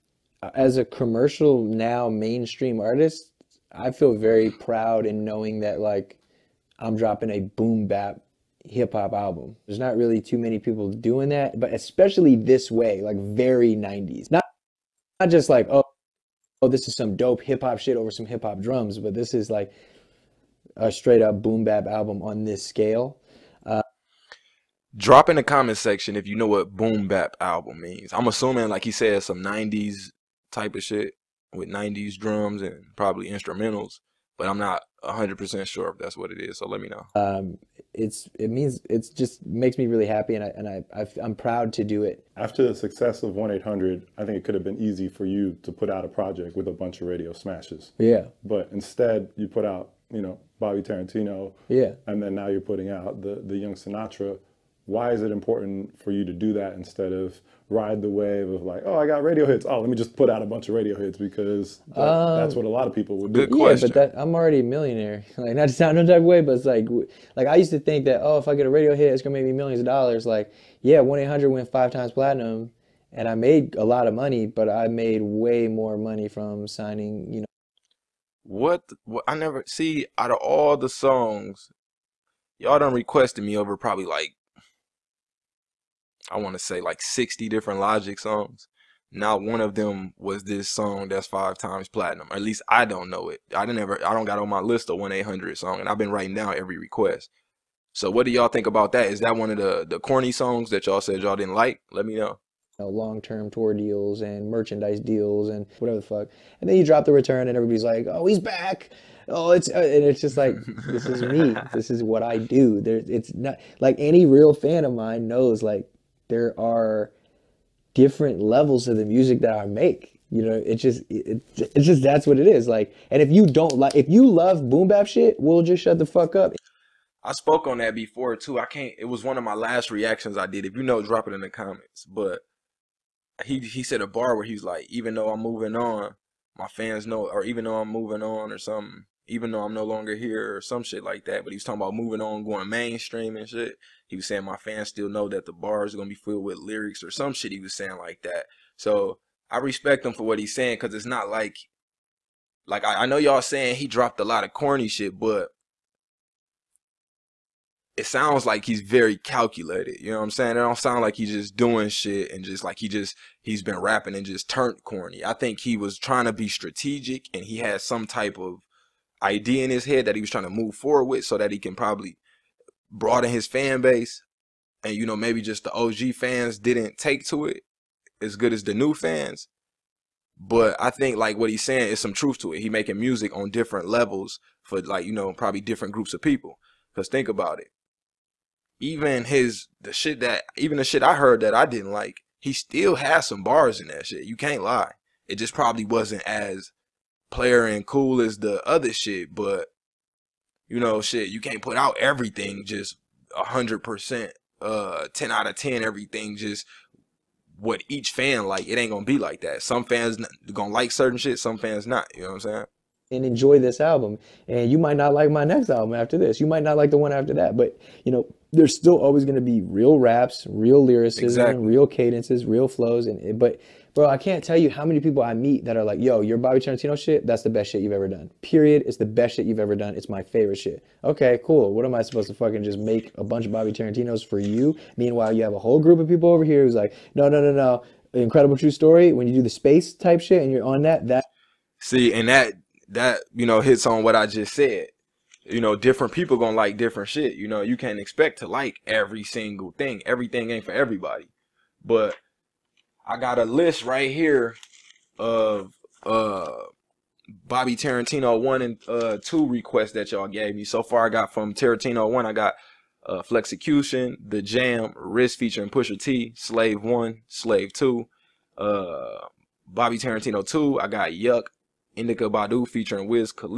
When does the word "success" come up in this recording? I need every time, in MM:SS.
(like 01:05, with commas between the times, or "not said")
00:42.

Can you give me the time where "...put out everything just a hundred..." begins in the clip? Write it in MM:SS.
03:21.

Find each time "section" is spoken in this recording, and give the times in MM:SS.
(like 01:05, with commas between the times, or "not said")
00:25.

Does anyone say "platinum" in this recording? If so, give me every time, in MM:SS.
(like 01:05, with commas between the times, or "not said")
01:12, 01:31.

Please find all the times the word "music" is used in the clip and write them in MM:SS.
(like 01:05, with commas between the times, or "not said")
01:59, 03:02.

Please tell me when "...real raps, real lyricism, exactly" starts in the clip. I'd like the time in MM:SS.
03:39.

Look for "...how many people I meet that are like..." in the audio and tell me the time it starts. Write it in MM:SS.
03:44.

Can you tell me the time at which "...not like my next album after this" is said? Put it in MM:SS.
03:34.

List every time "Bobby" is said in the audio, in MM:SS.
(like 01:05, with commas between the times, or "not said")
00:50, 03:46, 03:53, 04:17, 04:29.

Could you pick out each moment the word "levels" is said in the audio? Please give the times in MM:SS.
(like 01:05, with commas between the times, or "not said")
01:58, 03:03.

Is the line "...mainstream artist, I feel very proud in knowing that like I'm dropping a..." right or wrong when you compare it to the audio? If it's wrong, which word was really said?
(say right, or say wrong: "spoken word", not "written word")
right.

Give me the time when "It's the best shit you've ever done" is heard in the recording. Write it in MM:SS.
03:48.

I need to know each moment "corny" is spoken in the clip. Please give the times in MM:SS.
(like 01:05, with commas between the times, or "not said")
01:39, 02:34, 02:44.